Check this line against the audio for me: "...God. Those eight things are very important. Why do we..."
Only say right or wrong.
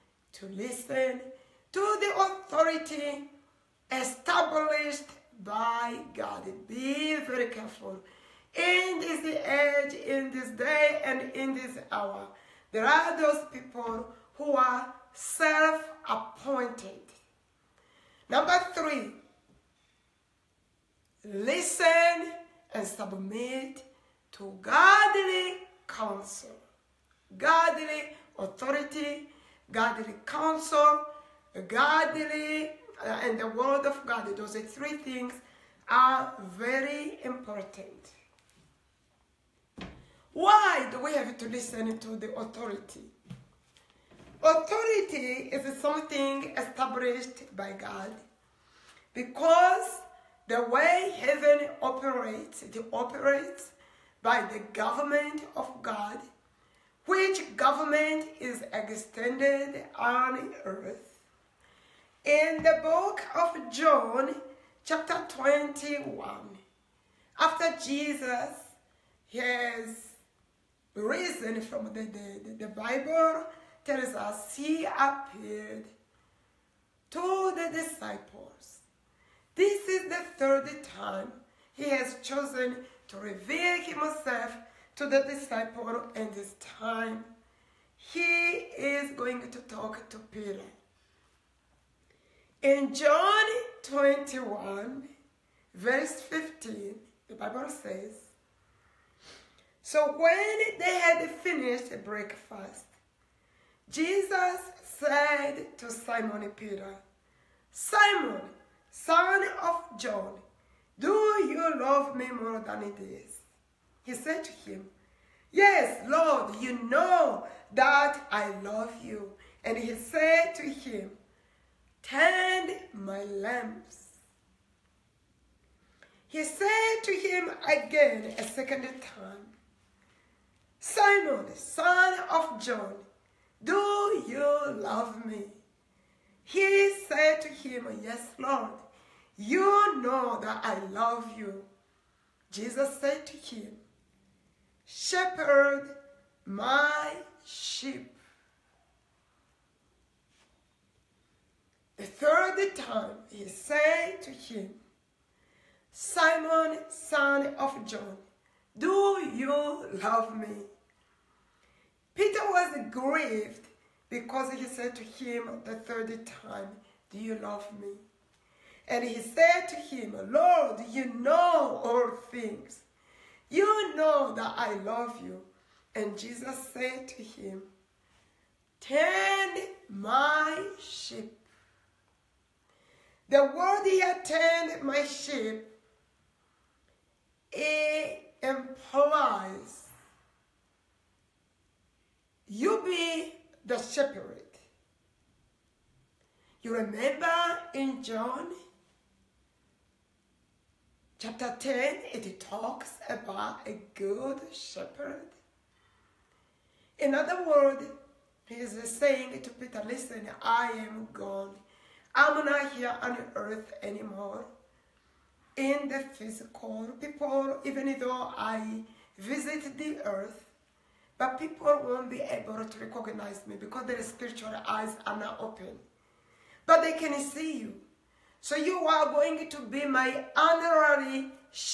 wrong.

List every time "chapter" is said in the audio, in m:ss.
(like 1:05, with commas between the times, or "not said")
1:04, 3:21.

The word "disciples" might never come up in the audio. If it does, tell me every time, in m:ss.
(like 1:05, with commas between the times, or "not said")
1:17, 1:25.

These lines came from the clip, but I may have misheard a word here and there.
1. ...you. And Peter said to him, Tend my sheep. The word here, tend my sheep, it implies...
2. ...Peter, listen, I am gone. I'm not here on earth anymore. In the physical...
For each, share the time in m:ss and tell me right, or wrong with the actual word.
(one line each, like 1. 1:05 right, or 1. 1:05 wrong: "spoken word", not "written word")
1. 2:55 wrong: "Jesus", not "Peter"
2. 3:29 right.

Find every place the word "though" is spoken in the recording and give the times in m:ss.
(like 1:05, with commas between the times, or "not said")
3:38.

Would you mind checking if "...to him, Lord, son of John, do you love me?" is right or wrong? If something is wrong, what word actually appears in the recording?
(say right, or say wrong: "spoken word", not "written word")
wrong: "Simon", not "Lord".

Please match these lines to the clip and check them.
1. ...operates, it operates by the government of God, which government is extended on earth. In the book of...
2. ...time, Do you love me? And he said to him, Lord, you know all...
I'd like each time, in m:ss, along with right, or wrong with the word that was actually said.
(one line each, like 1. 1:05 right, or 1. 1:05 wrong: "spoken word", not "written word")
1. 0:51 right
2. 2:46 right.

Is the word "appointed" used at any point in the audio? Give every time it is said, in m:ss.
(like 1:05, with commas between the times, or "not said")
0:15.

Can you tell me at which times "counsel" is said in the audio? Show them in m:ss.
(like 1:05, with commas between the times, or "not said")
0:25, 0:30.